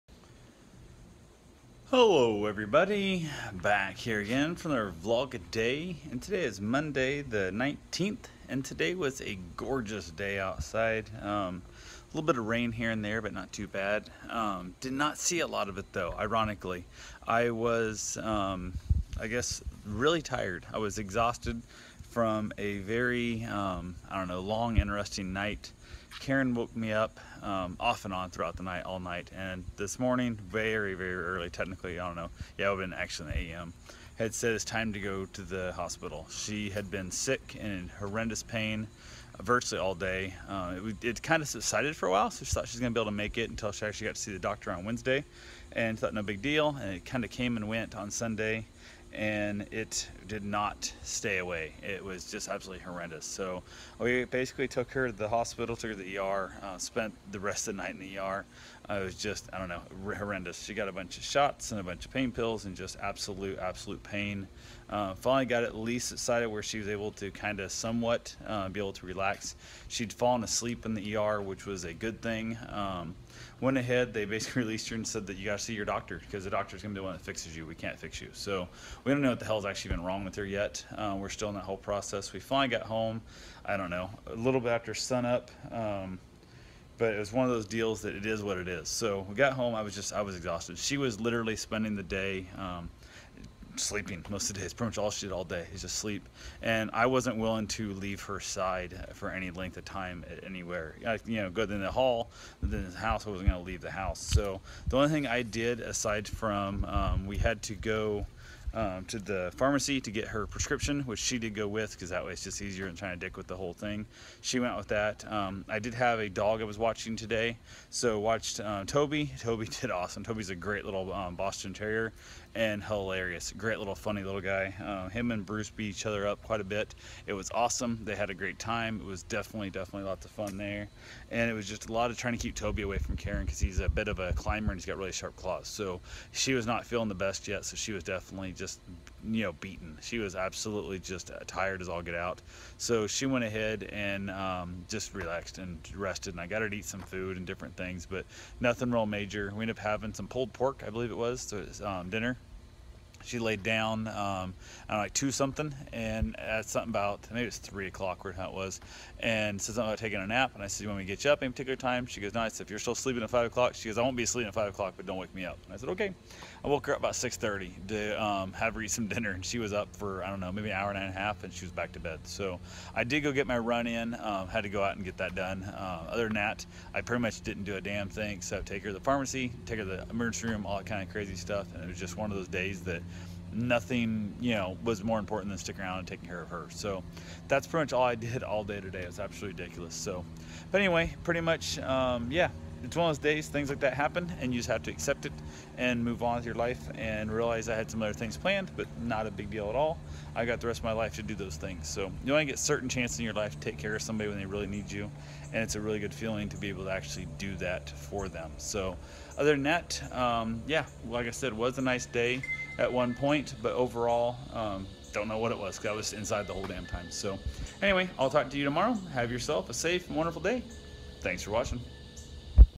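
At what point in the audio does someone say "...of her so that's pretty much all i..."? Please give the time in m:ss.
3:06.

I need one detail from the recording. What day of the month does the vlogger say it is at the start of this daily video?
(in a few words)
19th.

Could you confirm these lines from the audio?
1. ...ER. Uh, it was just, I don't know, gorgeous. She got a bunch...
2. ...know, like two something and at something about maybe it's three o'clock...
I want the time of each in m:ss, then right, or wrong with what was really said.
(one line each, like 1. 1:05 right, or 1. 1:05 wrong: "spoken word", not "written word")
1. 0:58 wrong: "horrendous", not "gorgeous"
2. 2:34 right.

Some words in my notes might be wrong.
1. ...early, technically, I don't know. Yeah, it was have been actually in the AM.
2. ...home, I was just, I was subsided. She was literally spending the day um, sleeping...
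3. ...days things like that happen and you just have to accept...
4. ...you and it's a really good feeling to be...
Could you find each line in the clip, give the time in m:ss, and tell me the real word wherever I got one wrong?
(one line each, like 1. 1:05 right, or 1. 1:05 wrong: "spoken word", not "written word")
1. 0:31 right
2. 1:29 wrong: "exhausted", not "subsided"
3. 3:13 right
4. 3:24 right.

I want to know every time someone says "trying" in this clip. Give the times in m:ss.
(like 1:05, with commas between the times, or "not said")
1:52, 2:12.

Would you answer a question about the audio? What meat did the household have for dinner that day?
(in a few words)
Pulled pork.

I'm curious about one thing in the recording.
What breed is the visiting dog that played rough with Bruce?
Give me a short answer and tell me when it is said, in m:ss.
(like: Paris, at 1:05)
Boston Terrier, at 2:01.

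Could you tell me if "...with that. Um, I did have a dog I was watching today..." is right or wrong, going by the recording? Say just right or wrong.
right.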